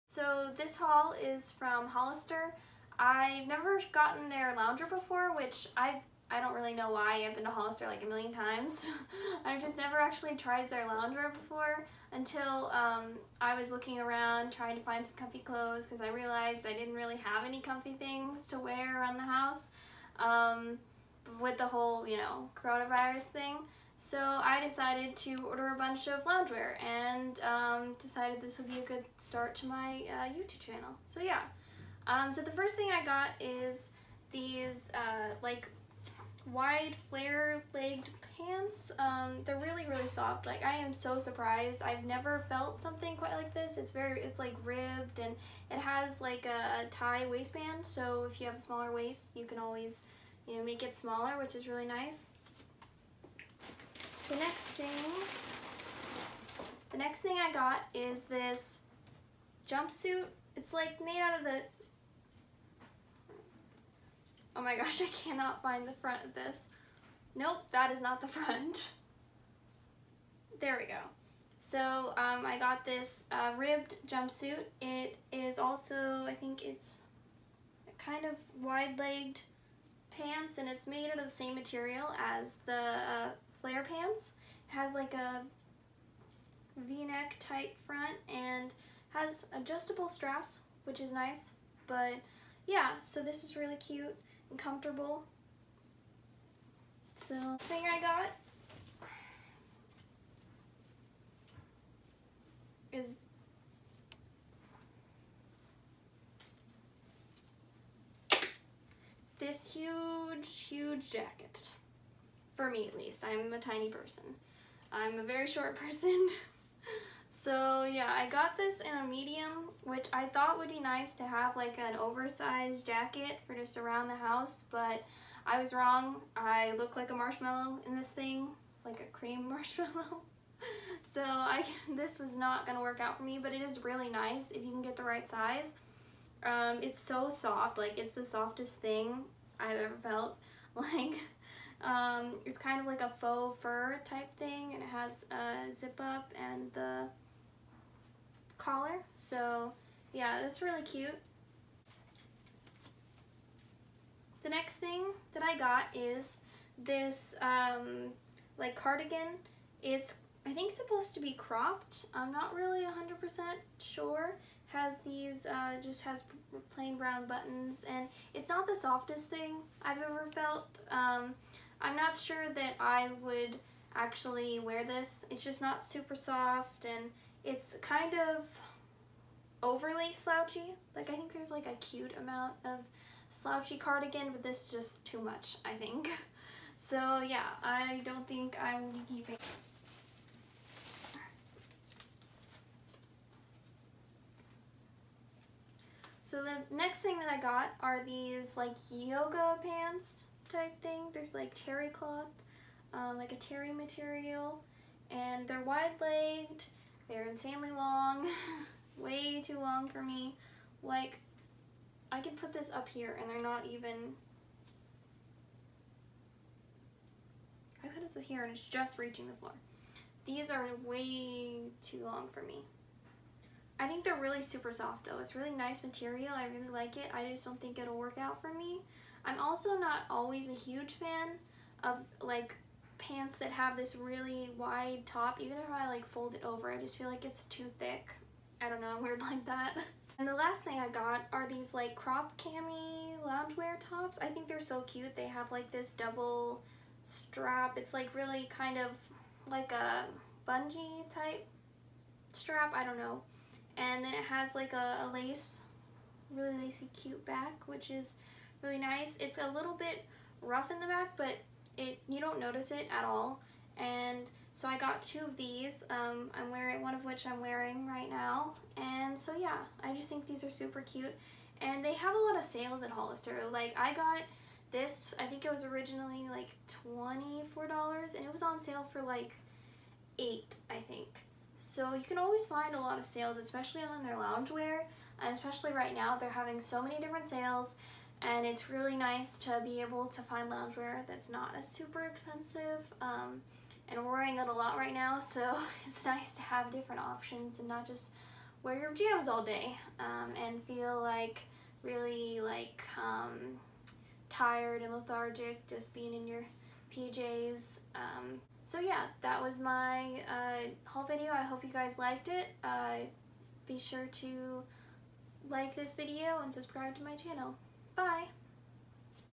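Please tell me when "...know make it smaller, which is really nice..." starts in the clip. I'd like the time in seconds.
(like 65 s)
50 s.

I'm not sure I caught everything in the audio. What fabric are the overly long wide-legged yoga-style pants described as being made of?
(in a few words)
terry cloth.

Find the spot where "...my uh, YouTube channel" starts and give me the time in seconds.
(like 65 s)
29 s.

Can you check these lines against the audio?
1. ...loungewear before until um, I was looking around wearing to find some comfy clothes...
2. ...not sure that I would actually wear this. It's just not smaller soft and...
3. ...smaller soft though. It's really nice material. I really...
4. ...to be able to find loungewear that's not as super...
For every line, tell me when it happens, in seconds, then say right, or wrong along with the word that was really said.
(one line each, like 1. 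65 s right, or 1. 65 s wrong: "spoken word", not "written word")
1. 10 s wrong: "trying", not "wearing"
2. 171 s wrong: "super", not "smaller"
3. 224 s wrong: "super", not "smaller"
4. 289 s right.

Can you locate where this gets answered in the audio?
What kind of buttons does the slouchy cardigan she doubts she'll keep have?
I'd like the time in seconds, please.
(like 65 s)
166 s.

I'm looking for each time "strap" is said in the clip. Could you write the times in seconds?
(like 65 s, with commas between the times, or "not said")
90 s, 247 s, 252 s.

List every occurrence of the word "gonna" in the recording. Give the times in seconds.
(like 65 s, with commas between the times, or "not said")
132 s.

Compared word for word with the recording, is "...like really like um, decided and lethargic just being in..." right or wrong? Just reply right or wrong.
wrong.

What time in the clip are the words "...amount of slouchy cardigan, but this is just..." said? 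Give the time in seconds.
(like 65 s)
182 s.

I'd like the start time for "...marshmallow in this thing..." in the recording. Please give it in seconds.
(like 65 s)
127 s.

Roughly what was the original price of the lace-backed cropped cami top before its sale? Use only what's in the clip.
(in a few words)
$24.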